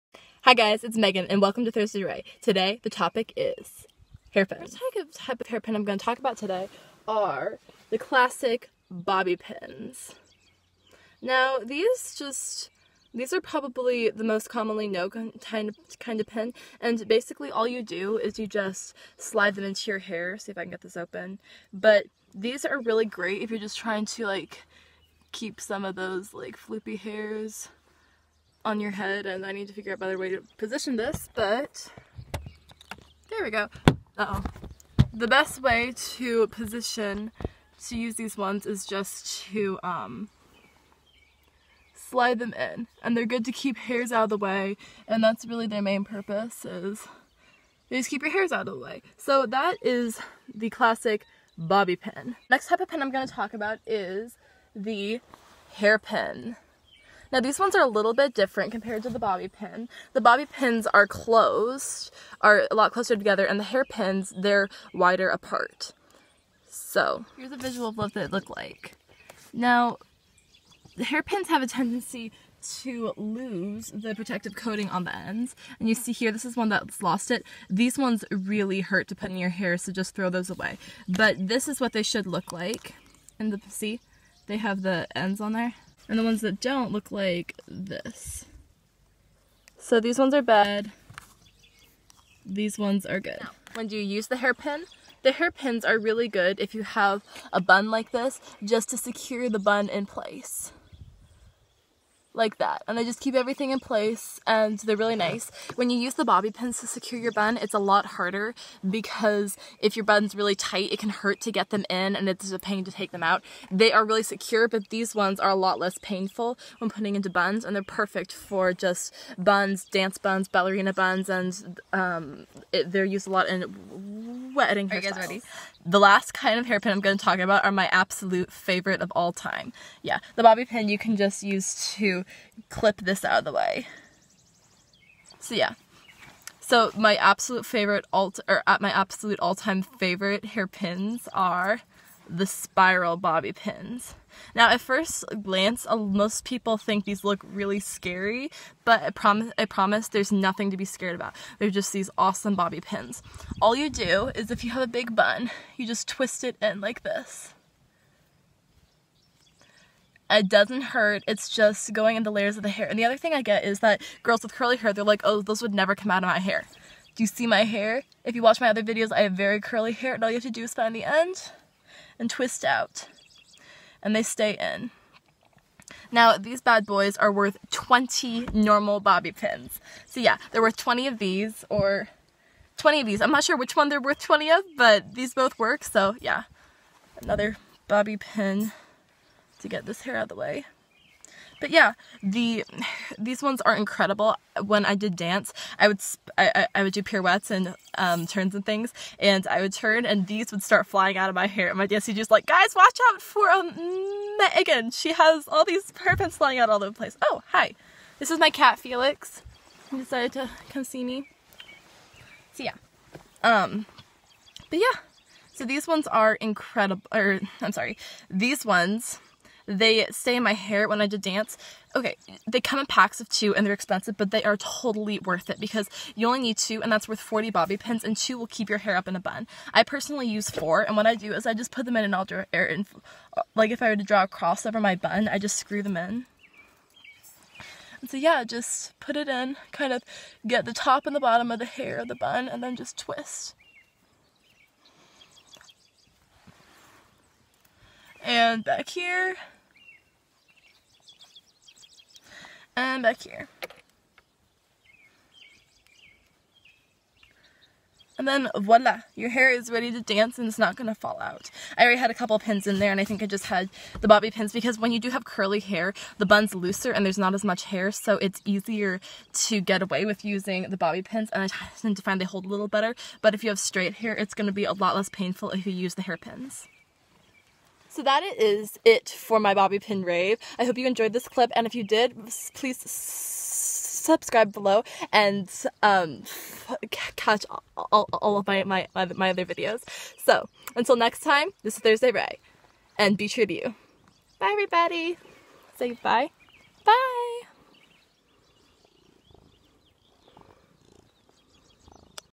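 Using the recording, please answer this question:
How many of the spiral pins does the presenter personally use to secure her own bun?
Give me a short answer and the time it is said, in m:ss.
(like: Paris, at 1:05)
4, at 3:50.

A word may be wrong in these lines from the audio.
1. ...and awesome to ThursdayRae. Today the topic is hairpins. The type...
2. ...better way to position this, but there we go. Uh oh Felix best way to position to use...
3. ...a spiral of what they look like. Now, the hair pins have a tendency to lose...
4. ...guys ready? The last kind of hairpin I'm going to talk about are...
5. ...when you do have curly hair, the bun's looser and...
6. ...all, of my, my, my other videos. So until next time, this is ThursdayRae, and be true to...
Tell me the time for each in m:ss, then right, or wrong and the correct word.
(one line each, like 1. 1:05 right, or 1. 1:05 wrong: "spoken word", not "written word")
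1. 0:01 wrong: "welcome", not "awesome"
2. 0:29 wrong: "The", not "Felix"
3. 1:07 wrong: "visual", not "spiral"
4. 2:05 right
5. 4:24 right
6. 4:48 right.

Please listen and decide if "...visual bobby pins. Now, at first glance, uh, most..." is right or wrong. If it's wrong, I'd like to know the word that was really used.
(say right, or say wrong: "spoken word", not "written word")
wrong: "spiral", not "visual".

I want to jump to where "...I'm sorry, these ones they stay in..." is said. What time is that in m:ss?
3:37.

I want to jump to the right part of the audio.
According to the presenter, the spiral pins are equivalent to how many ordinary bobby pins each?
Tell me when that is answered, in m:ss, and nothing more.
2:57.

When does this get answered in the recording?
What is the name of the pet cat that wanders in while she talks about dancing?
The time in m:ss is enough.
3:28.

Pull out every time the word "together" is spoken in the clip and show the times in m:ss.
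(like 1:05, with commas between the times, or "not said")
1:03.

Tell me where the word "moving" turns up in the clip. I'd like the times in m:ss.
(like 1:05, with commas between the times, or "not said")
not said.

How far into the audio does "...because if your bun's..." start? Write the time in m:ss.
1:48.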